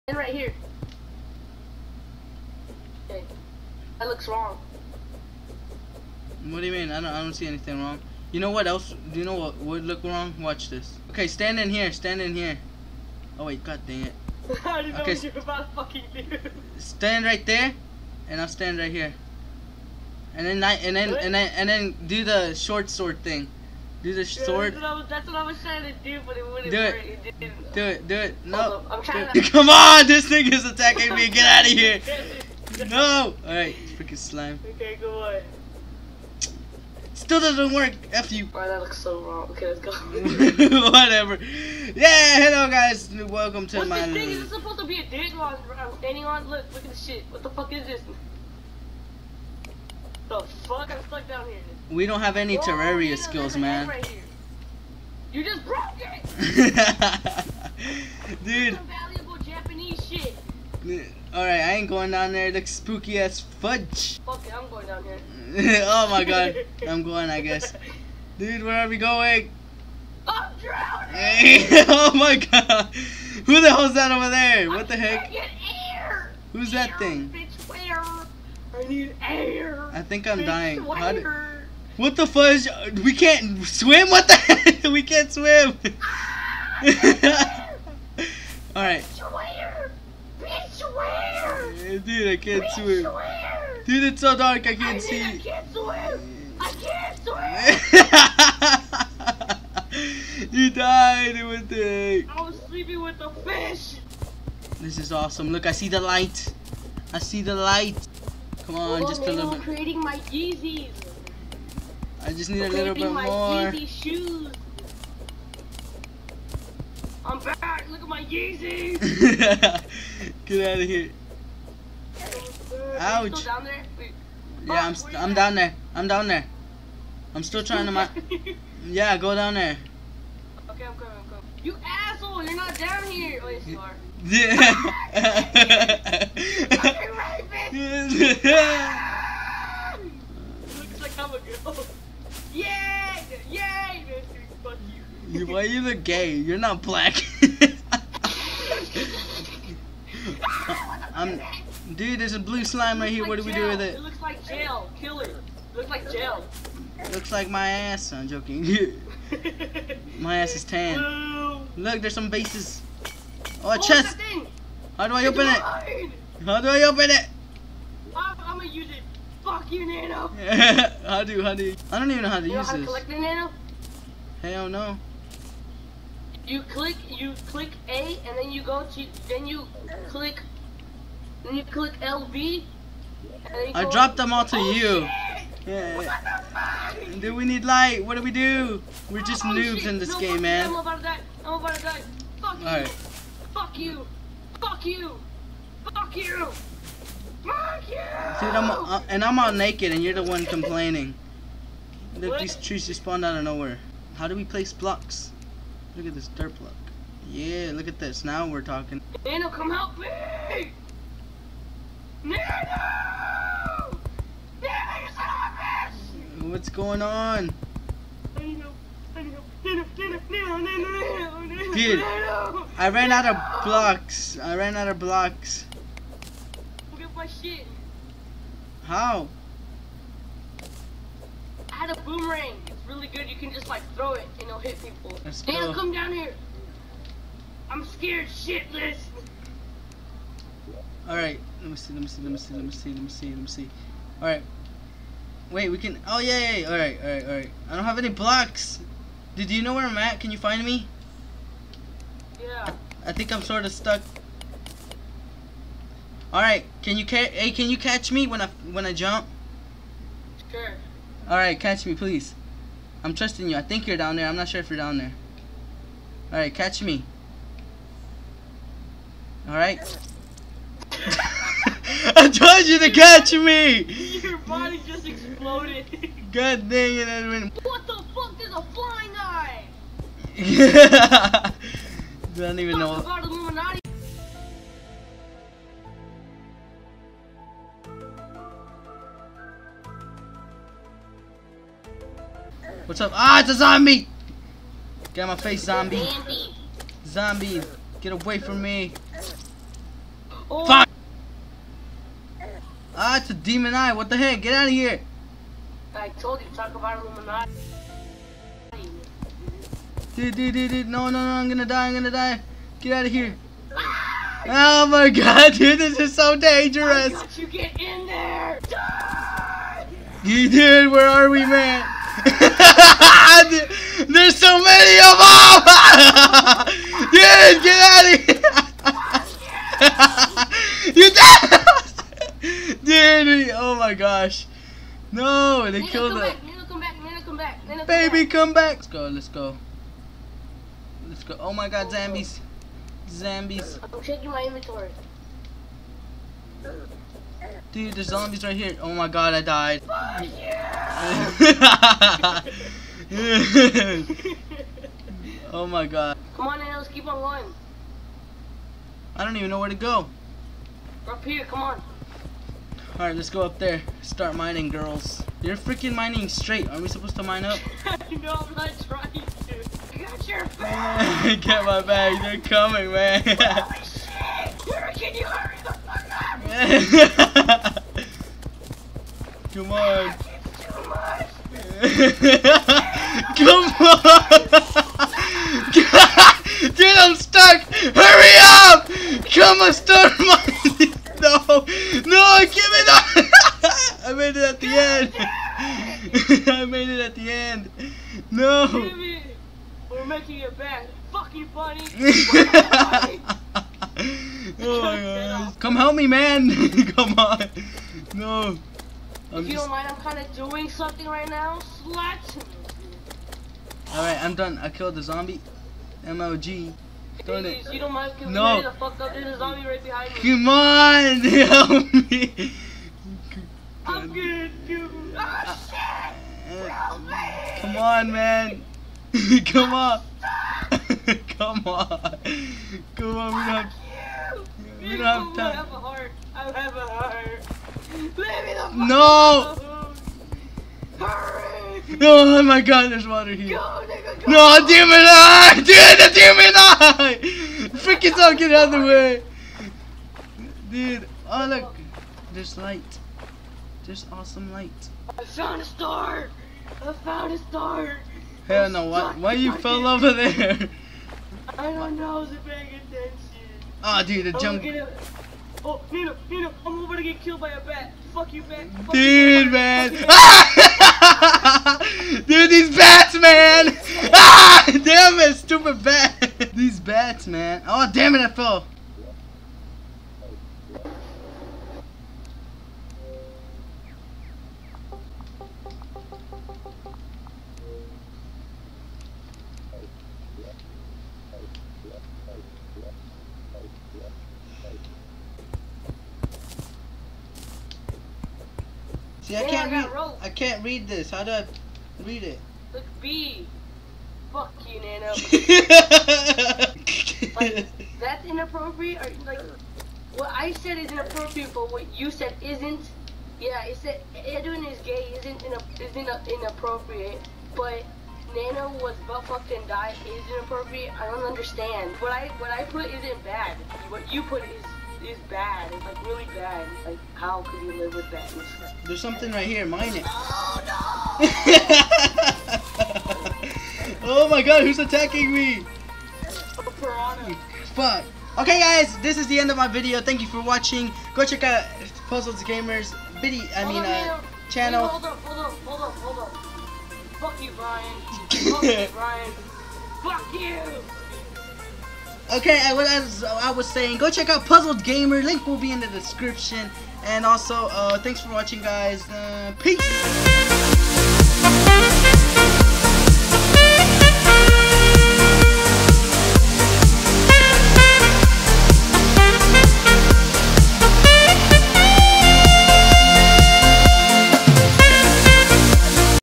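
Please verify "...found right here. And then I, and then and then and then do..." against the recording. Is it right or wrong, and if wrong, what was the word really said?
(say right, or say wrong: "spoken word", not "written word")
wrong: "stand", not "found".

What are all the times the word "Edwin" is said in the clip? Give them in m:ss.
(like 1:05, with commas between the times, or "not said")
4:37, 8:34.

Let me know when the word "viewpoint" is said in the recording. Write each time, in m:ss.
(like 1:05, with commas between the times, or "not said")
not said.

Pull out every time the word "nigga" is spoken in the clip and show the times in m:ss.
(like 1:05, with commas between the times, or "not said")
7:23.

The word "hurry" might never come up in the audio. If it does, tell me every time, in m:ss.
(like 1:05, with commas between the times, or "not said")
6:15, 6:27, 7:20.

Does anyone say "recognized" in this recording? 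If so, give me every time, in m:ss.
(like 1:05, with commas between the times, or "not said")
not said.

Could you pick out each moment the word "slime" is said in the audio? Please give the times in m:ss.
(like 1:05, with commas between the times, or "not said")
0:34, 2:32.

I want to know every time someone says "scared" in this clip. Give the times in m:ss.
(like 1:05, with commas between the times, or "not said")
3:57.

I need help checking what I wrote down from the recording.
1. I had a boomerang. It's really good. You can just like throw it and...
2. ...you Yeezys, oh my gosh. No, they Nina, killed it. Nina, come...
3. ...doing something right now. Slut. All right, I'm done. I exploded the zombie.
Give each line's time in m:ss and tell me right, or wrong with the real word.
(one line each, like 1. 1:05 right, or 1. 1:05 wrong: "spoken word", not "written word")
1. 3:51 right
2. 5:30 wrong: "Dude", not "Yeezys"
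3. 6:50 wrong: "killed", not "exploded".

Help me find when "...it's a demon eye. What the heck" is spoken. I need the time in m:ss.
5:03.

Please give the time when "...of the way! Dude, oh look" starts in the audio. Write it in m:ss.
7:28.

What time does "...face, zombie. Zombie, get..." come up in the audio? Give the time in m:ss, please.
4:55.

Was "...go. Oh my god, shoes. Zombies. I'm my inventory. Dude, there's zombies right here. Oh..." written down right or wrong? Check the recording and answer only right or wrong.
wrong.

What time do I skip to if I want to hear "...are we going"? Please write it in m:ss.
1:08.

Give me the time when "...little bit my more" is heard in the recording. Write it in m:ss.
1:52.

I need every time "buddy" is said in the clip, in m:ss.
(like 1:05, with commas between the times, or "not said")
6:41.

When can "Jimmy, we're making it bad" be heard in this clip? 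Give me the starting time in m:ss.
6:38.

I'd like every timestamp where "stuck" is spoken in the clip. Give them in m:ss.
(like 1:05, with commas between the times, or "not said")
0:51, 4:13, 6:27.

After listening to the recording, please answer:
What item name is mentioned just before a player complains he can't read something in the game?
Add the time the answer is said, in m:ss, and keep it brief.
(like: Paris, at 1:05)
Rope, at 8:19.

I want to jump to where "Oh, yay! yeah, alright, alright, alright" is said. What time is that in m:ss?
4:06.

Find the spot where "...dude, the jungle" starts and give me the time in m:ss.
7:44.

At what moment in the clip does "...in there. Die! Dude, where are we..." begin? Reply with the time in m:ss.
5:17.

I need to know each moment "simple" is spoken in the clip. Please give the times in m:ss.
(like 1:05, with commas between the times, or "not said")
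not said.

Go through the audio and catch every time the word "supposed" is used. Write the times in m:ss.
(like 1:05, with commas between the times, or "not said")
0:44, 6:06.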